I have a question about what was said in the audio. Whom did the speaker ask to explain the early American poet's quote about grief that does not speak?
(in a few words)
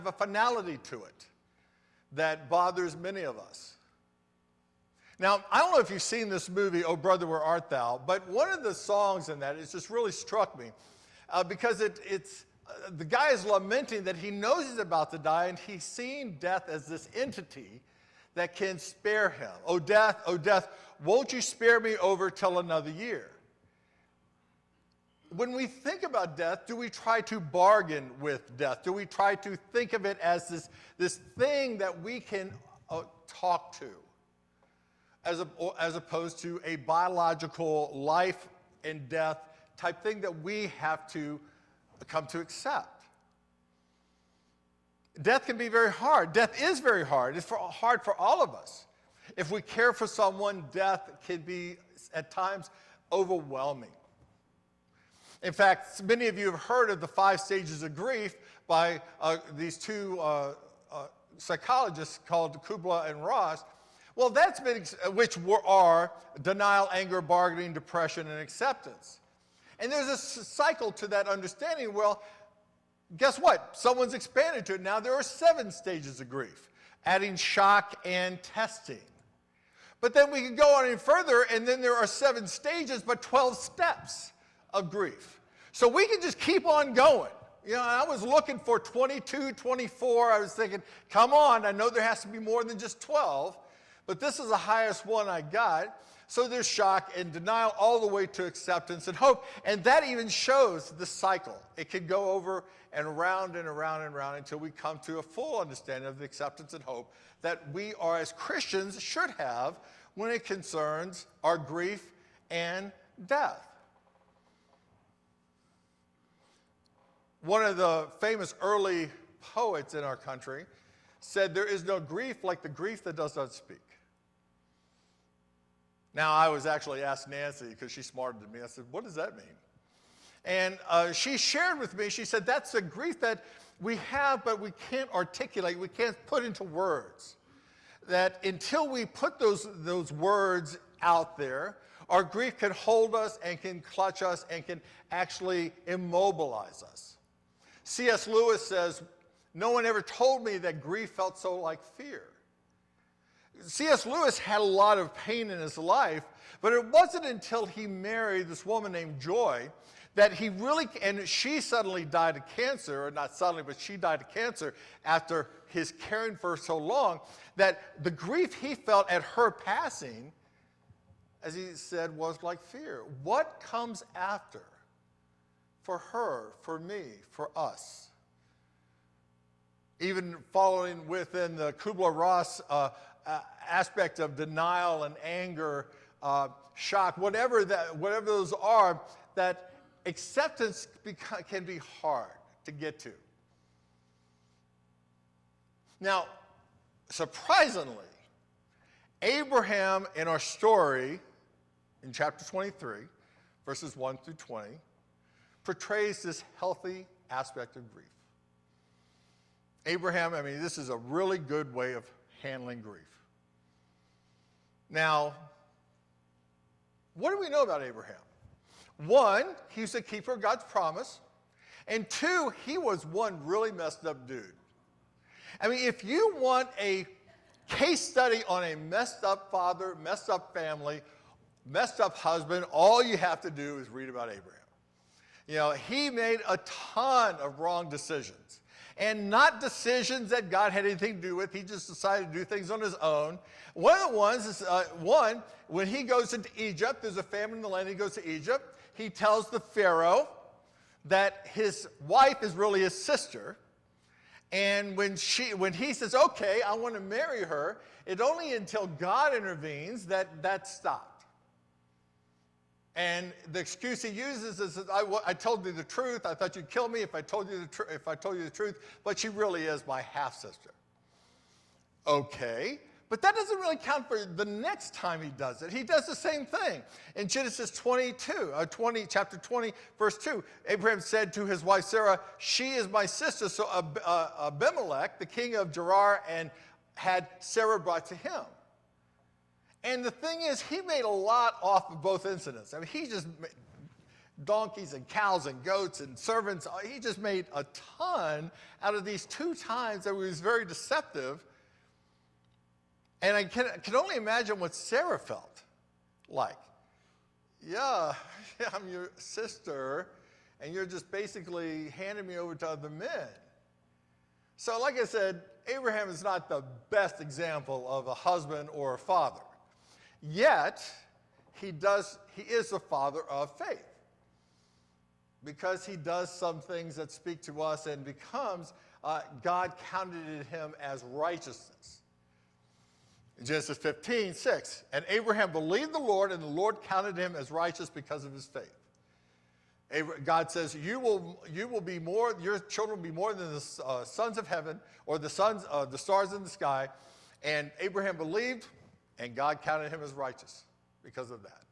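Nancy.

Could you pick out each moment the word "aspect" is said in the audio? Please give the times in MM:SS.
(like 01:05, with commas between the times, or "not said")
03:03, 03:27.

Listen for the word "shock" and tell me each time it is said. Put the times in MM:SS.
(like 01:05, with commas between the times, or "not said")
01:17, 01:36, 03:06.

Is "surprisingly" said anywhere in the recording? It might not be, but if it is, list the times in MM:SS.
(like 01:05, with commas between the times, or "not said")
03:17.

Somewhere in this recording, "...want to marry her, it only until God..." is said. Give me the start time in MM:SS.
04:16.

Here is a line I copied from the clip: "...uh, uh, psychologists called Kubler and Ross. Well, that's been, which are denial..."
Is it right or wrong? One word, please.
right.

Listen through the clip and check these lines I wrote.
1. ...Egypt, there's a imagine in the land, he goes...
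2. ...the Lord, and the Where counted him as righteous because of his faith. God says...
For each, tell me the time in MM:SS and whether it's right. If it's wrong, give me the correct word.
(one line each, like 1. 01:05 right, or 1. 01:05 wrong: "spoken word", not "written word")
1. 04:06 wrong: "famine", not "imagine"
2. 05:35 wrong: "Lord", not "Where".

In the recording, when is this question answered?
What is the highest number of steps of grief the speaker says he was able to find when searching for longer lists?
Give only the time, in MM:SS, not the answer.
01:23.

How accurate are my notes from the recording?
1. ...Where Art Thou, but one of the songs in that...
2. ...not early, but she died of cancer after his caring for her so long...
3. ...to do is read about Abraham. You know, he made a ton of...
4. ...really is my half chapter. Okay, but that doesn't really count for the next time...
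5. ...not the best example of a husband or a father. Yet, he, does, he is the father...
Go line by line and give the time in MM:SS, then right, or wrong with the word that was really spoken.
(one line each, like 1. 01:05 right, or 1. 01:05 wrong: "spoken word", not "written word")
1. 00:07 right
2. 02:43 wrong: "suddenly", not "early"
3. 03:53 right
4. 04:29 wrong: "sister", not "chapter"
5. 05:16 right.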